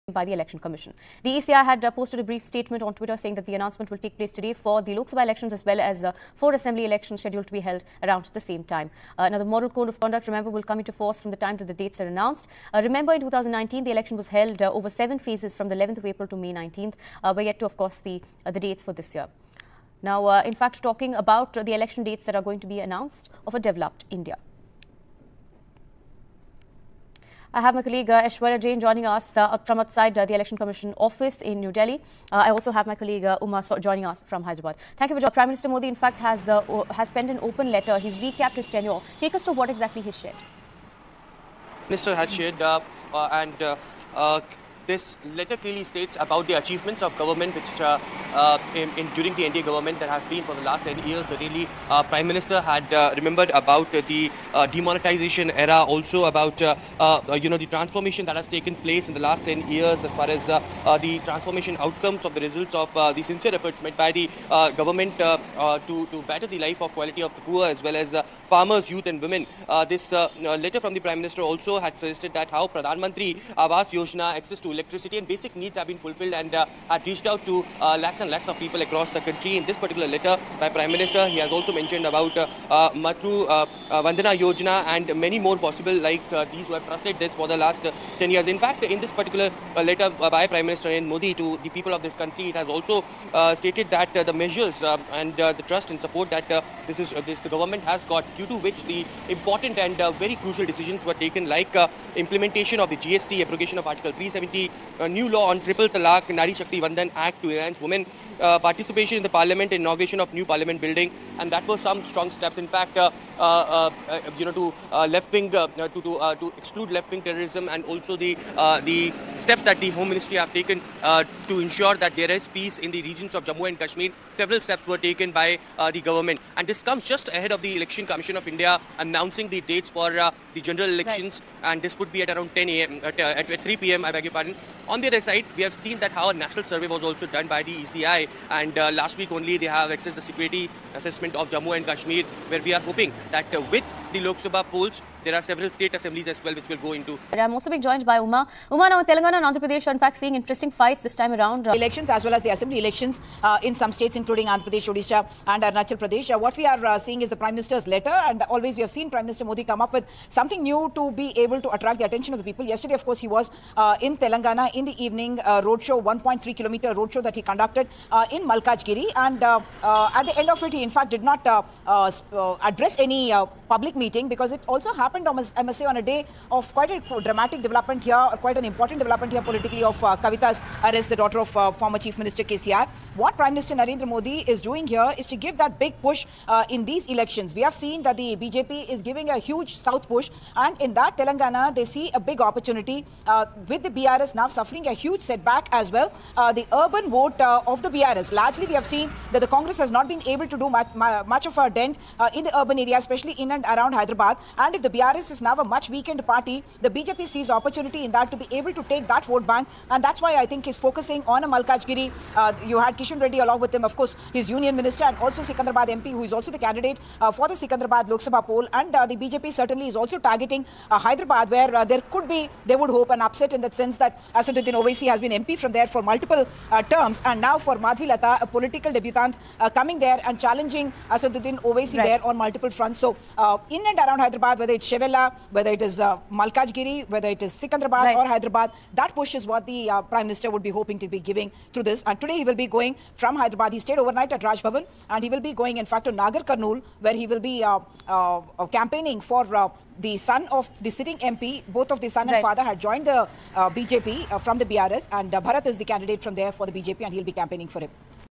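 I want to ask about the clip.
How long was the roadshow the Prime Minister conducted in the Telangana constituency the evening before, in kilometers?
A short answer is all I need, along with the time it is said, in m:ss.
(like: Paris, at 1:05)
1.3 kilometers, at 2:46.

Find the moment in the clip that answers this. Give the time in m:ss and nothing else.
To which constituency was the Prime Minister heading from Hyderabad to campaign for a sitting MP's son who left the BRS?
4:06.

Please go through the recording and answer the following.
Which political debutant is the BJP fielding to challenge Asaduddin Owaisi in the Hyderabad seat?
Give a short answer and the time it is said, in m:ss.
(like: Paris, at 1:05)
Madhvi Lata, at 3:47.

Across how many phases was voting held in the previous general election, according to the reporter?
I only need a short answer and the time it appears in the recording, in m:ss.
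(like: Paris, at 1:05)
7, at 0:14.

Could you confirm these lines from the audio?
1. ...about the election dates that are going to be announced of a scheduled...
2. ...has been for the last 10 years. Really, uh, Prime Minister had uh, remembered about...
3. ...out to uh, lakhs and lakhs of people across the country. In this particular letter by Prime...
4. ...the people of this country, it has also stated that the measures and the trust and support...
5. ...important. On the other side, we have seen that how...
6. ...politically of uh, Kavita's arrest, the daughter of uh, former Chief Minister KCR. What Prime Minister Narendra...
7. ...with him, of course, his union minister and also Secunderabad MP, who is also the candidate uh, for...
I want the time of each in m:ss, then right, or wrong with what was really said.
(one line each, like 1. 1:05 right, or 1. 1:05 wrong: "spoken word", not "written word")
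1. 0:21 wrong: "developed", not "scheduled"
2. 0:50 right
3. 1:17 right
4. 1:31 right
5. 2:14 right
6. 2:59 right
7. 3:33 right.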